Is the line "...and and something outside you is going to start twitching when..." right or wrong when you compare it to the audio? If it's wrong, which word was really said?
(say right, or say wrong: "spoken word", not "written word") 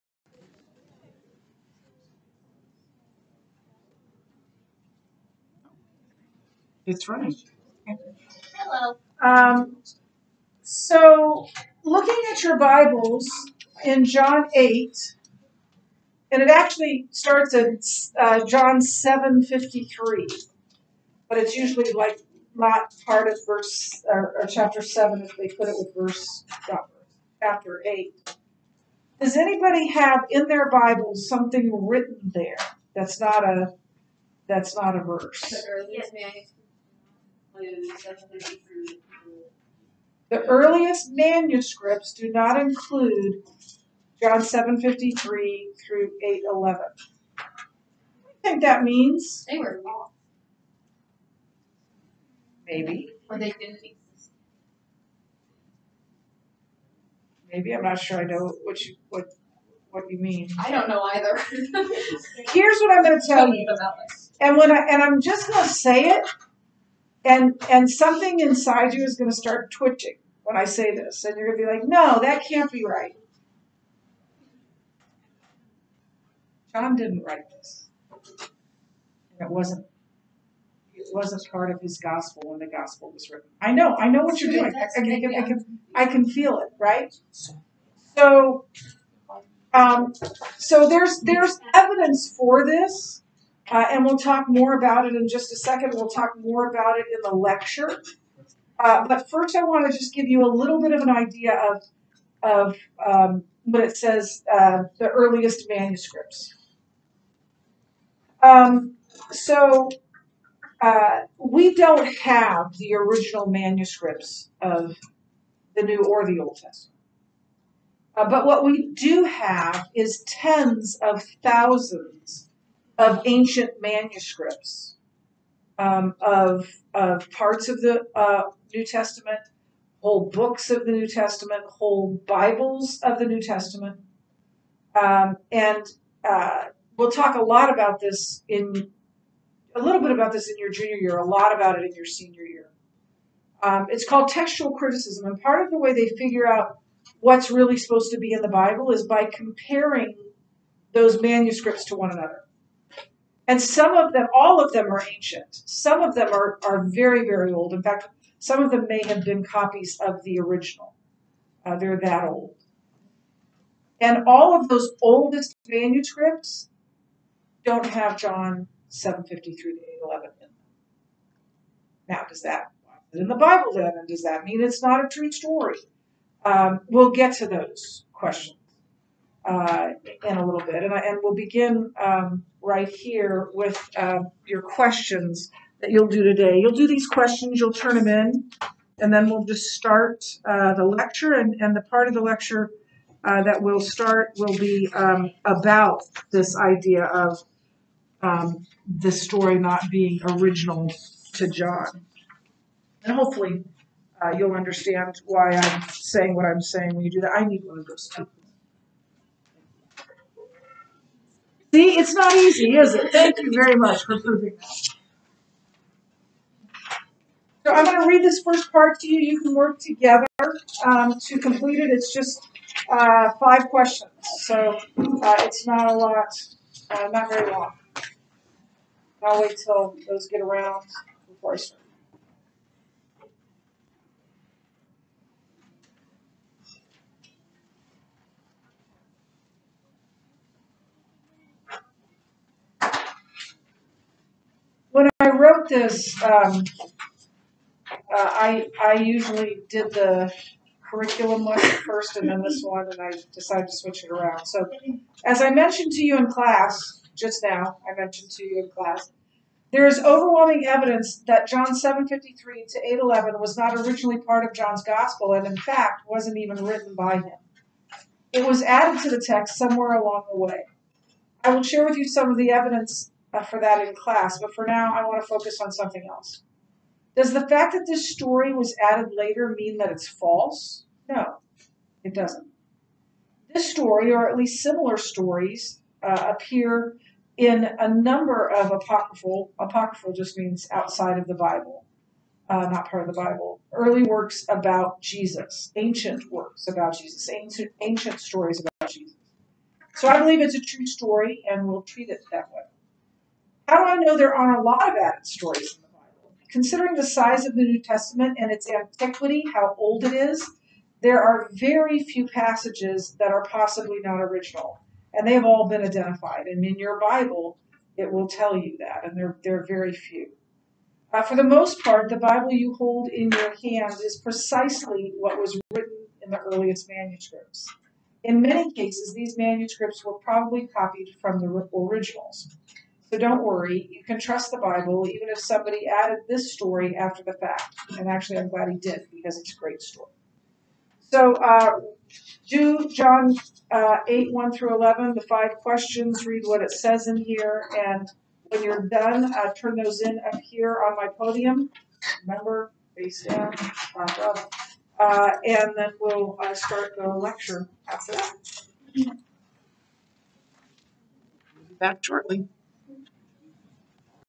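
wrong: "inside", not "outside".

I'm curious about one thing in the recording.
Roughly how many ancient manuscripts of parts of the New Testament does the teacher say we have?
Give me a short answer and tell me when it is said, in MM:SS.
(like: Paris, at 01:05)
tens of thousands, at 02:00.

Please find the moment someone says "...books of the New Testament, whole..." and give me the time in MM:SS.
02:10.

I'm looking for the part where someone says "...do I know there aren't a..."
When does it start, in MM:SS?
05:03.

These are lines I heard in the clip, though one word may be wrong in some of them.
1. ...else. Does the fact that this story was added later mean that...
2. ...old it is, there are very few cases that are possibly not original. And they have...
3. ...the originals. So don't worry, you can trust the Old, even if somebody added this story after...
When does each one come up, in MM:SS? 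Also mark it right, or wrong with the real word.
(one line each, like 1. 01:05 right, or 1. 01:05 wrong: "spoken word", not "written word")
1. 04:36 right
2. 05:09 wrong: "passages", not "cases"
3. 05:31 wrong: "Bible", not "Old".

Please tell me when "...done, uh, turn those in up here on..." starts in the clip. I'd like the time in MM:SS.
05:48.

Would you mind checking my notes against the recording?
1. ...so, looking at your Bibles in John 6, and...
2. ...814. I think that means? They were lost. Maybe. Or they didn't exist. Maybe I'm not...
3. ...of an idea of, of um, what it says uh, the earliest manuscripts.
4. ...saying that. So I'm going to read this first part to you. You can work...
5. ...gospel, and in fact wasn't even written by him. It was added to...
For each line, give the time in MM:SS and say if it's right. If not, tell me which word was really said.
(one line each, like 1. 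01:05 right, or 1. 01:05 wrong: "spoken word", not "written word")
1. 00:10 wrong: "8", not "6"
2. 00:46 wrong: "811", not "814"
3. 01:40 right
4. 03:34 wrong: "proving", not "saying"
5. 04:24 right.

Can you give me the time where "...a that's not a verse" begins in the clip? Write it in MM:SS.
00:33.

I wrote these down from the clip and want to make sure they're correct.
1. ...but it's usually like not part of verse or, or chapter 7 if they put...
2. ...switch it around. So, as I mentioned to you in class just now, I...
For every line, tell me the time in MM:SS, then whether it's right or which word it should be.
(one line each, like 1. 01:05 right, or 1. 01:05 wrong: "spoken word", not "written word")
1. 00:21 right
2. 04:13 right.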